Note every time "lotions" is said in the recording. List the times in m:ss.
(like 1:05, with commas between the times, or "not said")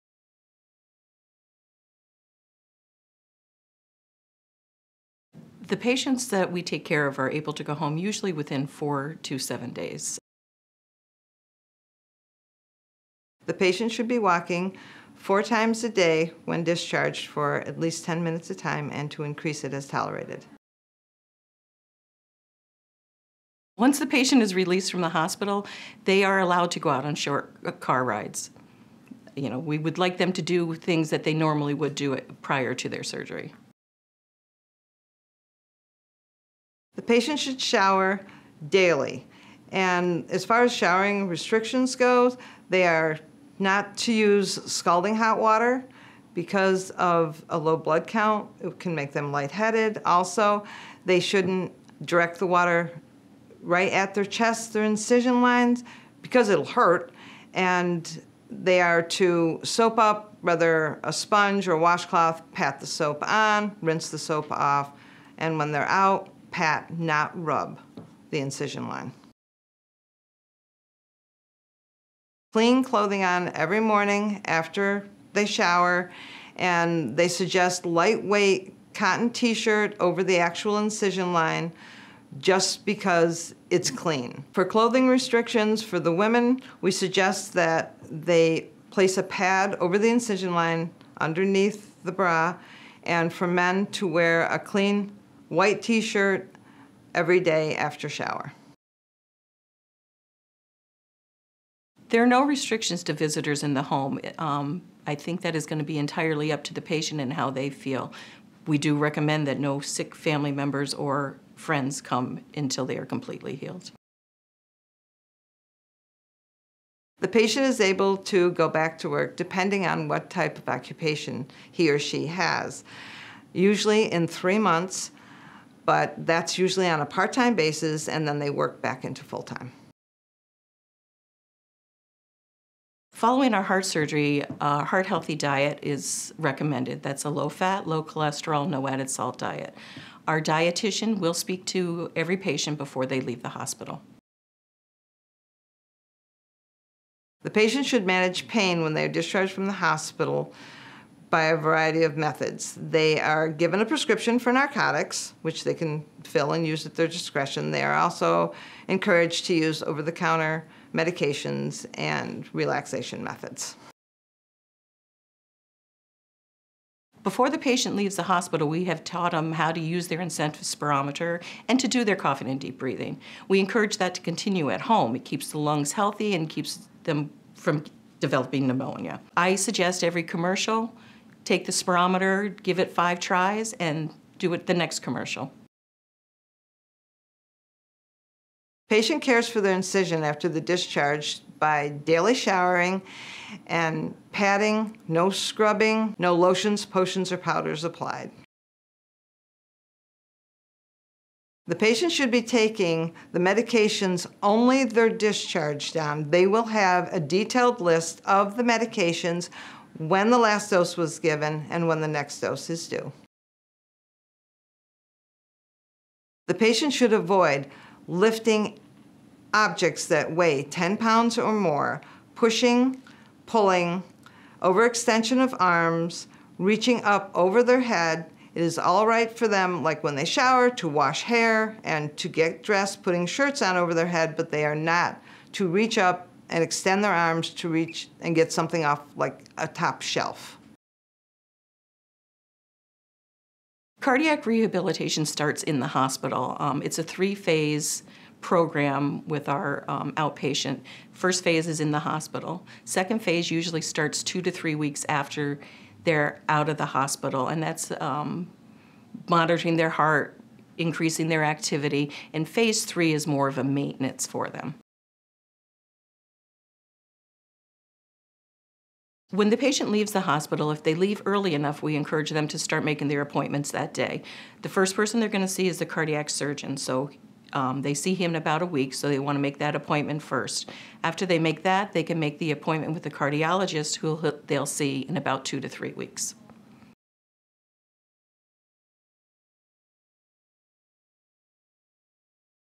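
3:16.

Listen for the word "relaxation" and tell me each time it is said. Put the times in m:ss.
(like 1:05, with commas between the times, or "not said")
2:42.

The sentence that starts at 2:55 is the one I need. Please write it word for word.
It keeps the lungs healthy and keeps them from developing pneumonia.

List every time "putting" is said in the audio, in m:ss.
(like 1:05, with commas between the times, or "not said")
3:53.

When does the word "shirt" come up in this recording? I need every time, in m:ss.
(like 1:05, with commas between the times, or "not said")
1:19, 1:35, 3:53.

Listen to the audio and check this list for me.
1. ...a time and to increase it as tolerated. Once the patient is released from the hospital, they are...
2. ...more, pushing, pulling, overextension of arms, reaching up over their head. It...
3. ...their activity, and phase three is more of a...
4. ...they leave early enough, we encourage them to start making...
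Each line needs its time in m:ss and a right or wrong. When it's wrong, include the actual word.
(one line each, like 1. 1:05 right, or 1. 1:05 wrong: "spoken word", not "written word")
1. 0:18 right
2. 3:41 right
3. 4:21 right
4. 4:30 right.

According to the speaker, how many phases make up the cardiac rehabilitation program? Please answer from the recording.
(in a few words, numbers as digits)
3.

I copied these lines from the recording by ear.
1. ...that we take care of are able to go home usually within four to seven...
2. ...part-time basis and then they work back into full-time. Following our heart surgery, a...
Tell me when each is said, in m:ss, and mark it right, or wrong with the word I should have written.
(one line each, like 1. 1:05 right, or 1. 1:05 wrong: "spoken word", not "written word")
1. 0:06 right
2. 2:07 right.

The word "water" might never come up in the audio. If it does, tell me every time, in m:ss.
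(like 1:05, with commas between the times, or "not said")
0:45, 0:52.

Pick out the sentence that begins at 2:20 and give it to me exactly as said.
Our dietitian will speak to every patient before they leave the hospital.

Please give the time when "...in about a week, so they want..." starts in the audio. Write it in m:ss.
4:38.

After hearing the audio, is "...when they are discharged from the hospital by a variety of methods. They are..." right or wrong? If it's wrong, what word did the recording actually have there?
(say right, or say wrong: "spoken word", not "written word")
right.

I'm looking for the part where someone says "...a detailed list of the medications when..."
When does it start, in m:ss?
3:27.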